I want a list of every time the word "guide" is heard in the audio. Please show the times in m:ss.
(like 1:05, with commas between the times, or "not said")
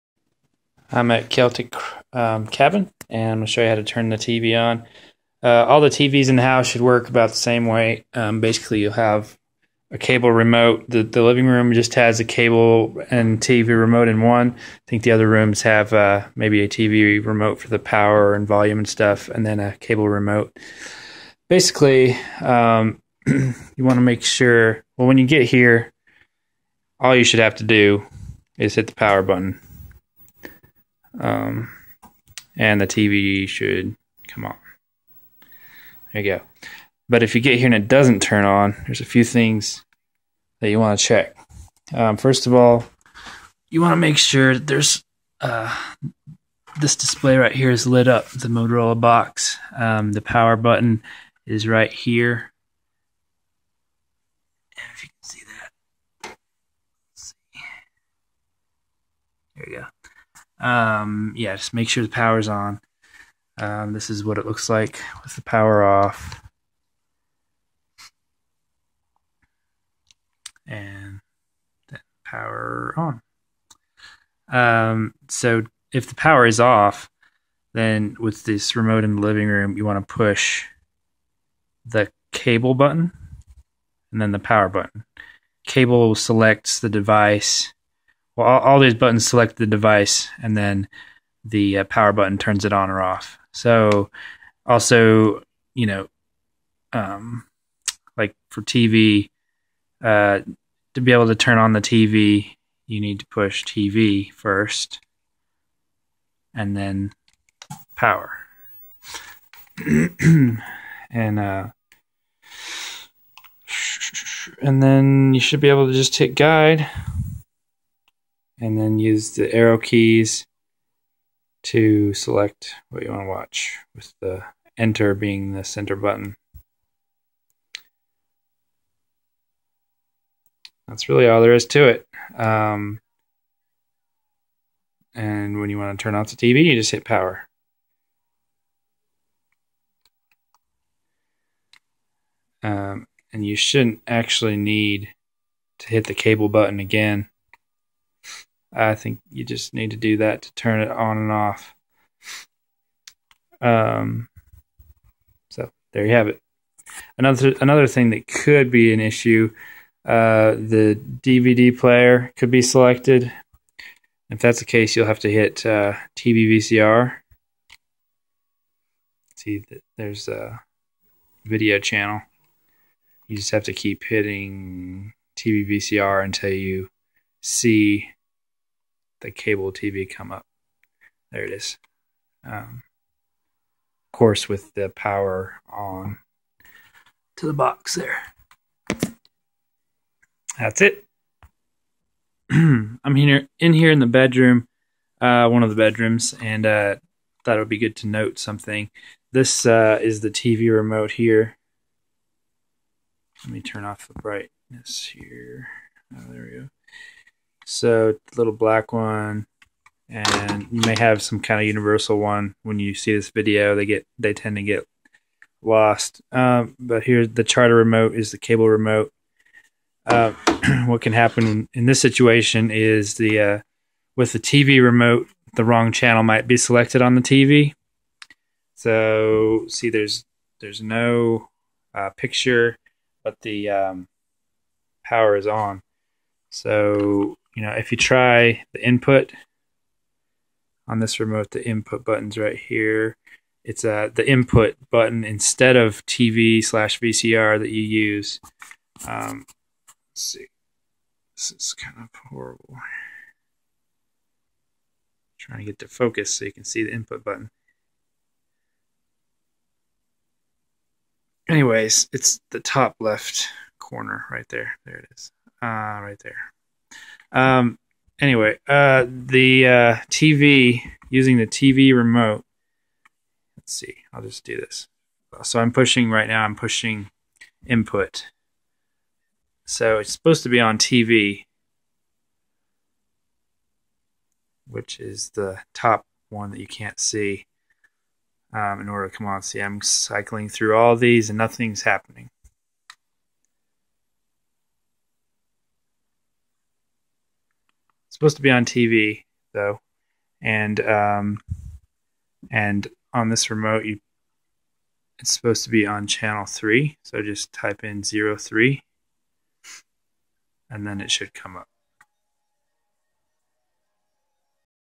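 1:56.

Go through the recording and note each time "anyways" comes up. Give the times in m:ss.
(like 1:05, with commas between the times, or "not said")
4:21, 4:28.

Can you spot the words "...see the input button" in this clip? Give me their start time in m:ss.
4:16.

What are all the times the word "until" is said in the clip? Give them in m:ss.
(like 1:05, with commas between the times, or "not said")
2:56.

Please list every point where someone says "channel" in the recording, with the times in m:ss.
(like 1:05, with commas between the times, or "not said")
2:51, 3:45, 5:06.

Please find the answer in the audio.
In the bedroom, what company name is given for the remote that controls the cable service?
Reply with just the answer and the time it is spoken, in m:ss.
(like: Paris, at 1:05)
Charter, at 3:37.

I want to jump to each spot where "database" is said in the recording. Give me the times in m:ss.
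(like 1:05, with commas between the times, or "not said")
not said.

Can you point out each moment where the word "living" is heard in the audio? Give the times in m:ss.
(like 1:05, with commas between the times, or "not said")
0:11, 1:19.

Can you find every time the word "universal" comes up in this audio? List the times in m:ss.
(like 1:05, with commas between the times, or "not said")
3:31.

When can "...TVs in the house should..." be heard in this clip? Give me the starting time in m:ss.
0:05.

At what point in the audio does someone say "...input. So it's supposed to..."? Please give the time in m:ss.
4:37.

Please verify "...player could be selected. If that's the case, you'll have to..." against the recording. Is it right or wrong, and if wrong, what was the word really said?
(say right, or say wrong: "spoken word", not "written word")
right.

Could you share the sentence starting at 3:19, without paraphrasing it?
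This uh, is the TV remote here.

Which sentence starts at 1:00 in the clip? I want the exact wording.
Um, yeah, just make sure the power's on.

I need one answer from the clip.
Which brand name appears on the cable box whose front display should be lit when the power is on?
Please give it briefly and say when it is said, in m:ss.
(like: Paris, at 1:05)
Motorola, at 0:48.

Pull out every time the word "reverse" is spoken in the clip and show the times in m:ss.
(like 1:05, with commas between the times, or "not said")
not said.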